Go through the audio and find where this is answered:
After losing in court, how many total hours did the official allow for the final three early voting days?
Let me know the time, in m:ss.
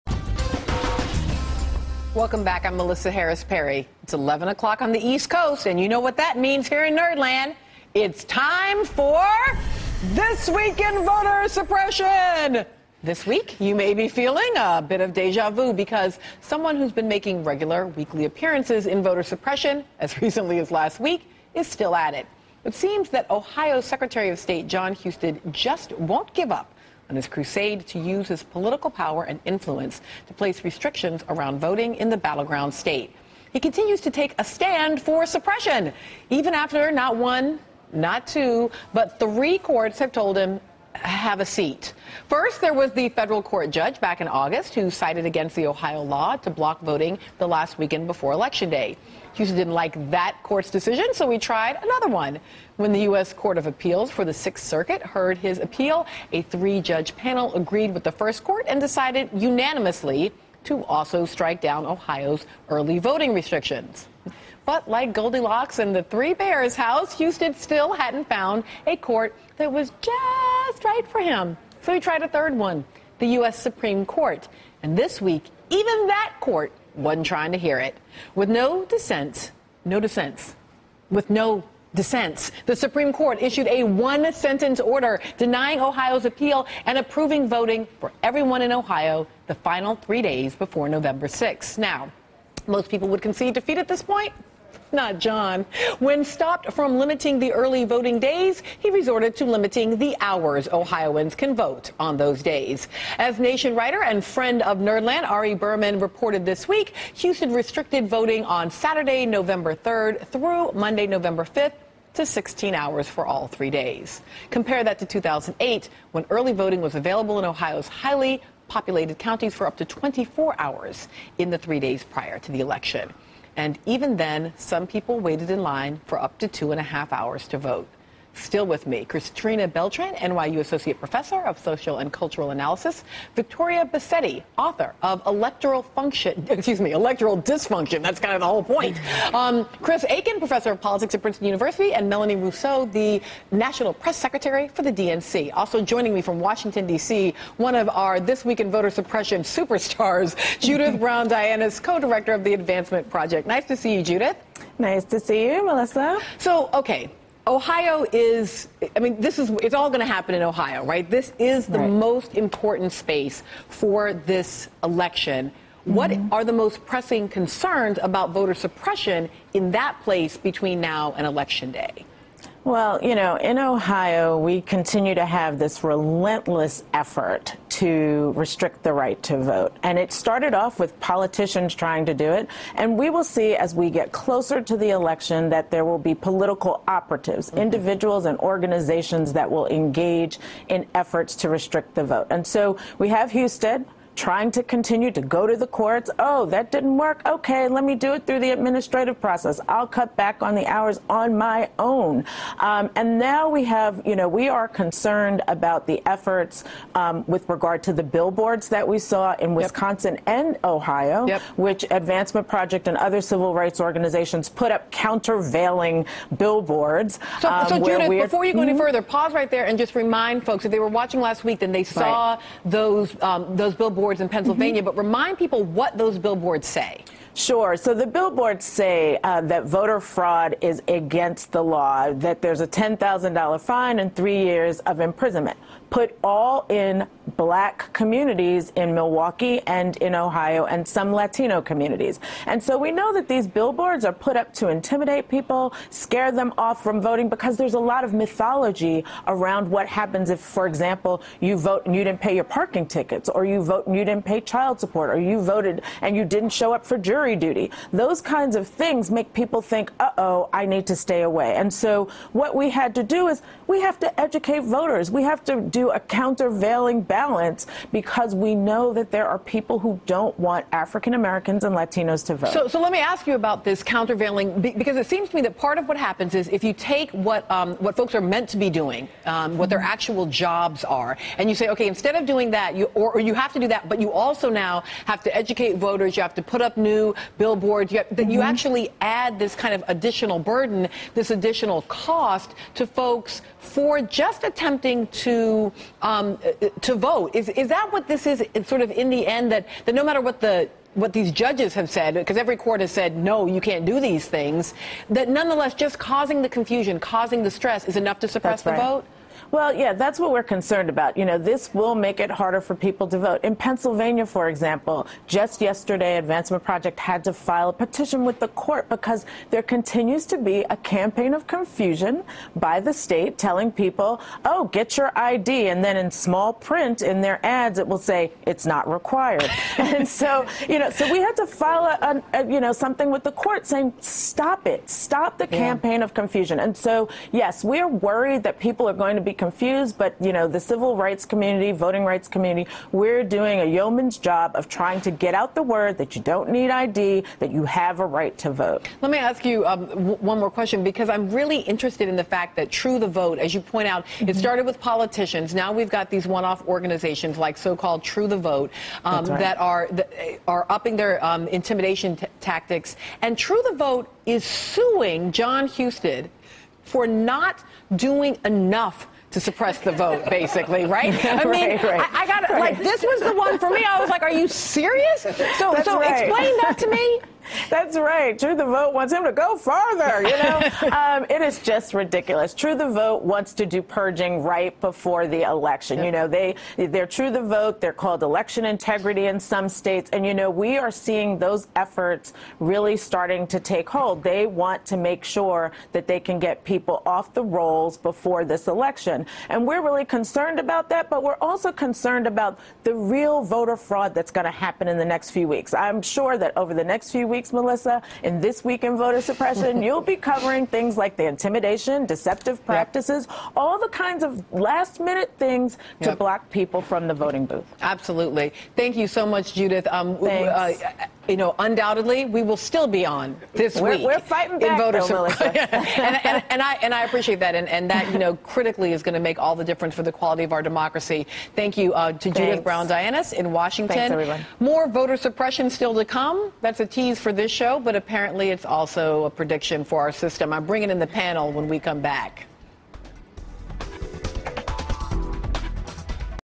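1:52.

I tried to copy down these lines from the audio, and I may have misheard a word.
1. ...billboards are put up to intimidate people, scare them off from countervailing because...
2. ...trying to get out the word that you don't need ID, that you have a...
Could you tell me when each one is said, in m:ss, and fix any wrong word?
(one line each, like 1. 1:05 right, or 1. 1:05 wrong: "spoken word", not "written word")
1. 4:03 wrong: "voting", not "countervailing"
2. 5:44 right.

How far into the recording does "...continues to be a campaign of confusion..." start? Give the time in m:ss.
5:19.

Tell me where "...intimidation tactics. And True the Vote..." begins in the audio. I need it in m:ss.
6:01.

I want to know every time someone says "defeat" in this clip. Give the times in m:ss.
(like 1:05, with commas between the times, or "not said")
1:33.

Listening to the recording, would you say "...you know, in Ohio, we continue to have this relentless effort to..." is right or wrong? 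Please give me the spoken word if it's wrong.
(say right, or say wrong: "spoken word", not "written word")
right.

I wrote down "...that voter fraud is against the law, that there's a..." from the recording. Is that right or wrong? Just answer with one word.
right.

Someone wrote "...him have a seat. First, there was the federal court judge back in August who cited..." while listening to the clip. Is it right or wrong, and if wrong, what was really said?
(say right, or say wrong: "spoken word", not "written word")
right.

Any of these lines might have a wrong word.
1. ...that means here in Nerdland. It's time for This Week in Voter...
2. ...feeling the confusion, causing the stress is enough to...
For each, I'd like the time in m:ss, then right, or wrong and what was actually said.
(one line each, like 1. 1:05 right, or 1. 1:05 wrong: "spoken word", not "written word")
1. 0:06 right
2. 5:05 wrong: "causing", not "feeling".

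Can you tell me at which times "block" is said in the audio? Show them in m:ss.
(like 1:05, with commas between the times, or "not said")
0:46, 6:56.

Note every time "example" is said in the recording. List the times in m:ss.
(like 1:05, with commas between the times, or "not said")
4:10, 5:14.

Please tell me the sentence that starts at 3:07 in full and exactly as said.
individuals and organizations that will engage in efforts to restrict the vote.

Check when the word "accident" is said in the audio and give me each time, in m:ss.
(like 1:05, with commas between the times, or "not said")
not said.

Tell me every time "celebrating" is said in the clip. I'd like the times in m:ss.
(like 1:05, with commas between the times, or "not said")
not said.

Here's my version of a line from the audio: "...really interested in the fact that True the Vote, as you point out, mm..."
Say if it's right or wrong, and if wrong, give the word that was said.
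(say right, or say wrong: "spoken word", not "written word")
right.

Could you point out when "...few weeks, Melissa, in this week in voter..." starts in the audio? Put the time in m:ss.
6:47.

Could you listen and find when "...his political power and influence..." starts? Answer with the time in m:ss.
0:28.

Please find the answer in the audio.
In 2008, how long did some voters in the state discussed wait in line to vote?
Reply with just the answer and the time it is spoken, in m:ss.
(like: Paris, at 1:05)
two and a half hours, at 2:06.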